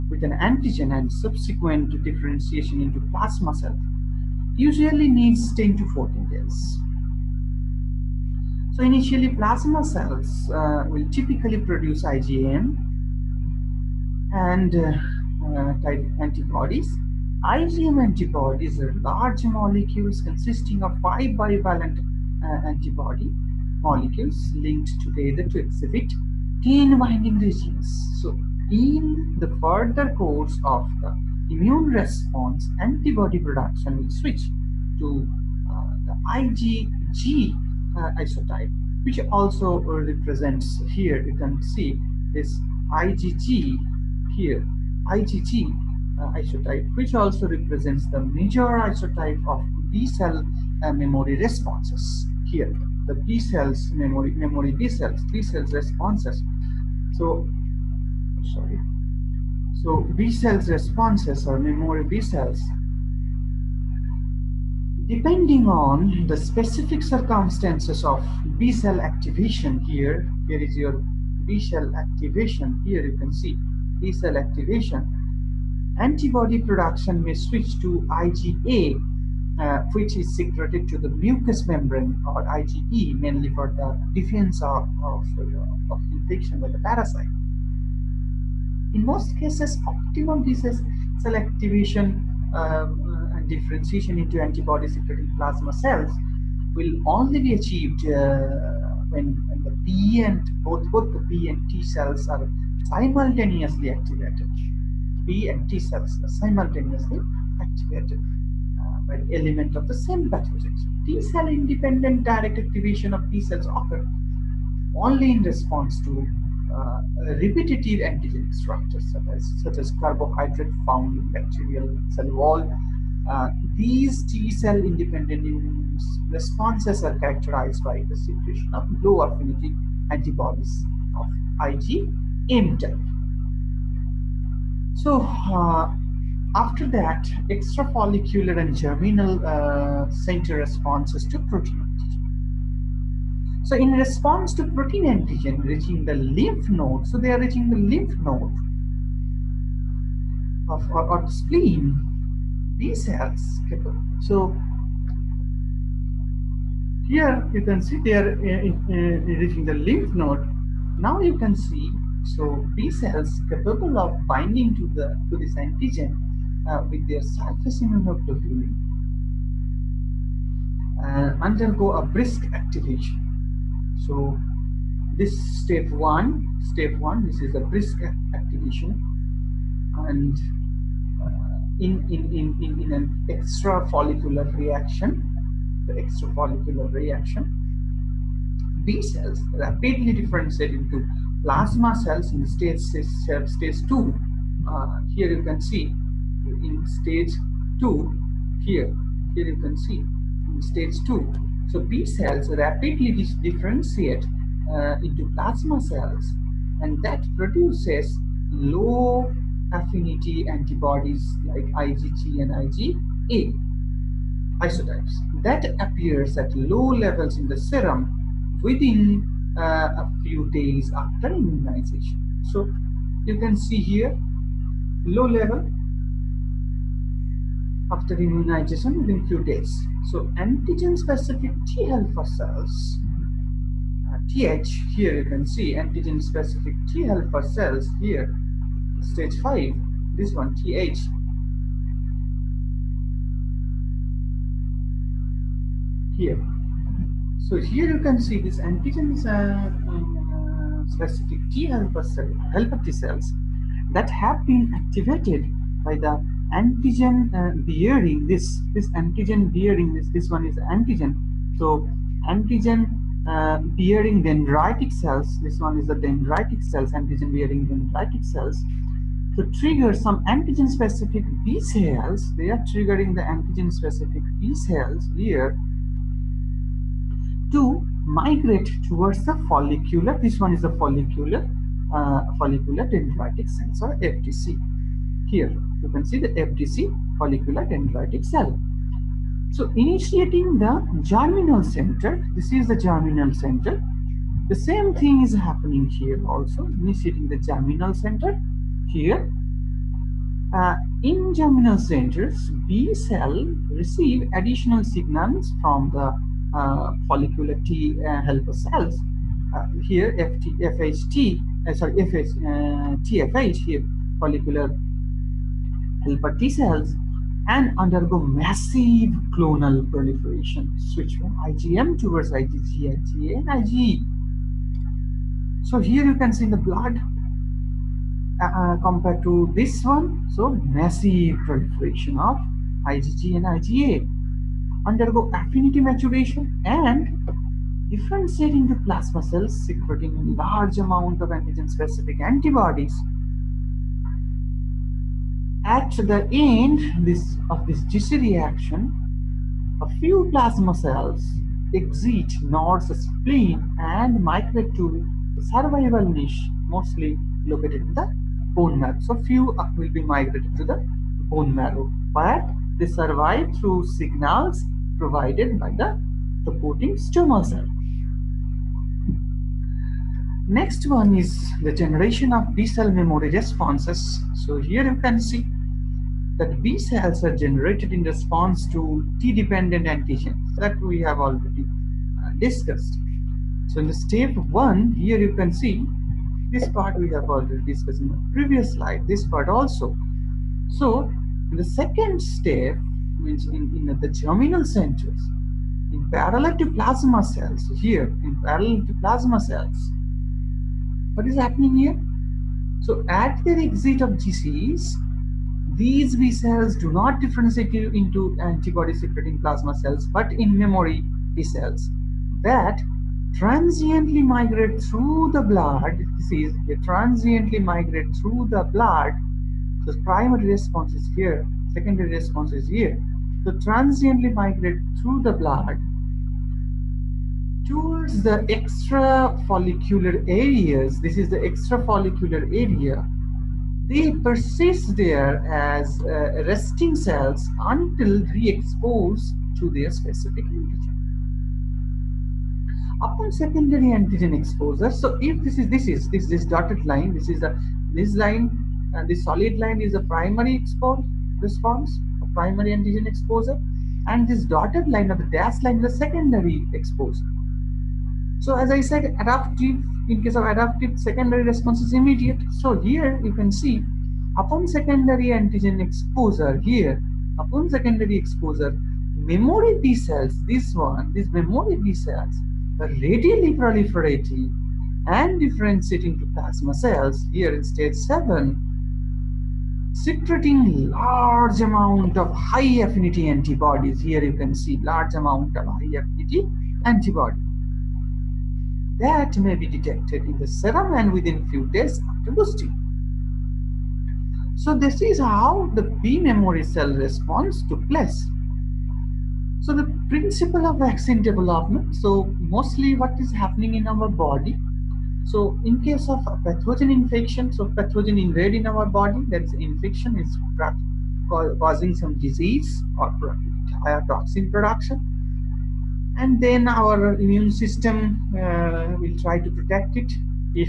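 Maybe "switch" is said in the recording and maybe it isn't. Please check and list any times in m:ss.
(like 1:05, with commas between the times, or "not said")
0:34, 1:17, 5:20.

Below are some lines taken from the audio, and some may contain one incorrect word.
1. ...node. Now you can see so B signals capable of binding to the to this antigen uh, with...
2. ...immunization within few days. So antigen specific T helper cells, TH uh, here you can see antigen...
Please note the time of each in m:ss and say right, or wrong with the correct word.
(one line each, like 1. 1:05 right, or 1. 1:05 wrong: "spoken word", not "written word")
1. 2:40 wrong: "cells", not "signals"
2. 3:48 right.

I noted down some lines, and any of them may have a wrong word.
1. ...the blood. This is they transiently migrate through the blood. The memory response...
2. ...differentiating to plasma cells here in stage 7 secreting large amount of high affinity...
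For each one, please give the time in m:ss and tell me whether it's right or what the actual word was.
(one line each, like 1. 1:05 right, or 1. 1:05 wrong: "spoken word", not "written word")
1. 6:55 wrong: "primary", not "memory"
2. 7:55 right.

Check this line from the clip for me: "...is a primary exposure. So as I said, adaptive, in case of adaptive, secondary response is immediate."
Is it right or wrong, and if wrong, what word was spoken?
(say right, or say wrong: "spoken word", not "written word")
wrong: "secondary", not "primary".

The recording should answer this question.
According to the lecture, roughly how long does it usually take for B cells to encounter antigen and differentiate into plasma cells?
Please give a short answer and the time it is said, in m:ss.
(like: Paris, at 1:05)
10 to 14 days, at 0:05.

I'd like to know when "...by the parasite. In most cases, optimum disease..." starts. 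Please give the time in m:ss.
1:26.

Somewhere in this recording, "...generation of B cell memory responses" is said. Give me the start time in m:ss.
6:11.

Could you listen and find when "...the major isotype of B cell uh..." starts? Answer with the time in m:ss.
0:48.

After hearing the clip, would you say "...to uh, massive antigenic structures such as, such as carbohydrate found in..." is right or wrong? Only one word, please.
wrong.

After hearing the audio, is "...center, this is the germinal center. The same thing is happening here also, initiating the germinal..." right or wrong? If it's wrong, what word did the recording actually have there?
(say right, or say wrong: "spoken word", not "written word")
right.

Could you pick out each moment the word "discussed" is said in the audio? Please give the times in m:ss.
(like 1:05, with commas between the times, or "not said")
6:22, 6:27.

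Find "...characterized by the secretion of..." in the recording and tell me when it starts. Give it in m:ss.
2:07.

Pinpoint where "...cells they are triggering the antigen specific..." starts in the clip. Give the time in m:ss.
4:31.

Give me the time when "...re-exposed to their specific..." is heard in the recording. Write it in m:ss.
7:18.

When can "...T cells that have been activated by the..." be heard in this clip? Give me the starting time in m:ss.
4:12.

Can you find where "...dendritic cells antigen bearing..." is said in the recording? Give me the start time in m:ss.
4:26.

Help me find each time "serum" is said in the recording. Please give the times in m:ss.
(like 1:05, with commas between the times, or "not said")
3:37, 8:10.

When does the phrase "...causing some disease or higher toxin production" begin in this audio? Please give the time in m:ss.
8:31.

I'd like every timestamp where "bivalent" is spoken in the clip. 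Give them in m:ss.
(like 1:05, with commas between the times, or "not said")
0:21.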